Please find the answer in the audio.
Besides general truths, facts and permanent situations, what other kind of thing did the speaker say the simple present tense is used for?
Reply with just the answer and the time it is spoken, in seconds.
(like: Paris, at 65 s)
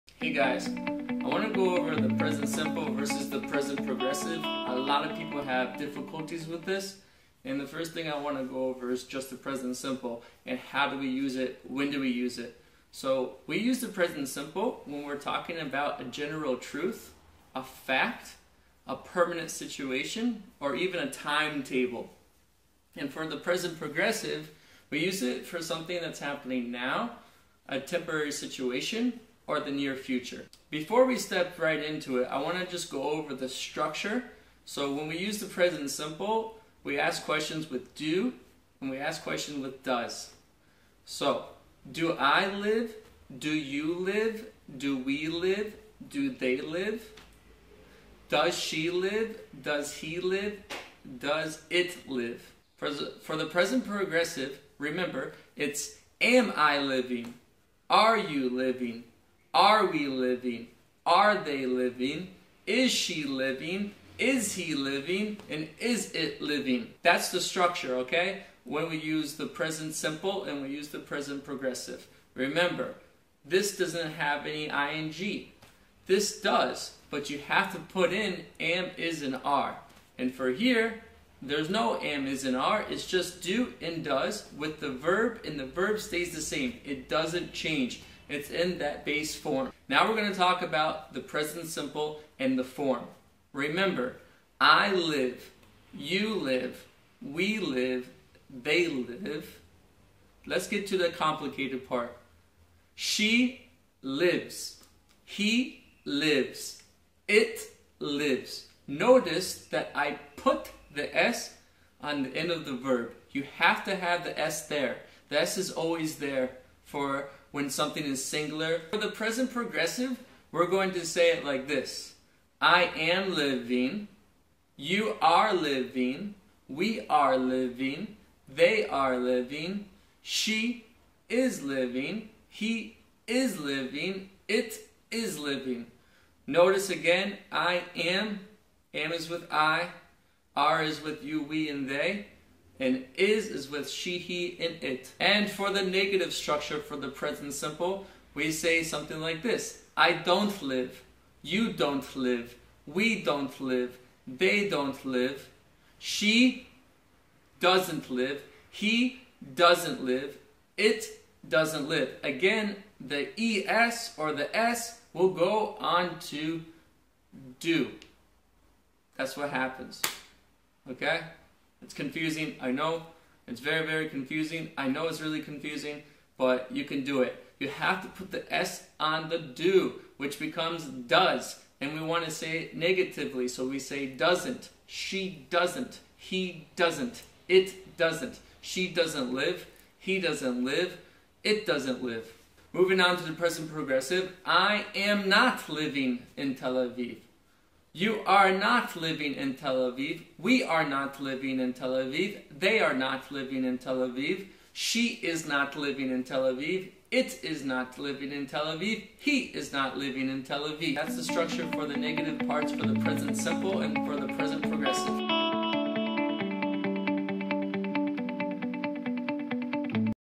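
a timetable, at 21 s.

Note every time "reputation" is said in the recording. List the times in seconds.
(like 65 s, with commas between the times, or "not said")
not said.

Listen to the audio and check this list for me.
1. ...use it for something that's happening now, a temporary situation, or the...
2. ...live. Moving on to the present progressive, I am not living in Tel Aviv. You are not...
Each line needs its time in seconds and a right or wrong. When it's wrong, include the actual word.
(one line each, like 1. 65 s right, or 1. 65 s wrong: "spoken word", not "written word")
1. 25 s right
2. 192 s right.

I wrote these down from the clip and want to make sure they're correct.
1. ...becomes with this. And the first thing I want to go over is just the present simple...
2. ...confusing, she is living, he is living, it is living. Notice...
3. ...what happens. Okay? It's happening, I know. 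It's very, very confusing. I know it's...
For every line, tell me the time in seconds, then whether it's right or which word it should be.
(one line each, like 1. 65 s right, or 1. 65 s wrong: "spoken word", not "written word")
1. 5 s wrong: "difficulties", not "becomes"
2. 129 s wrong: "living", not "confusing"
3. 169 s wrong: "confusing", not "happening".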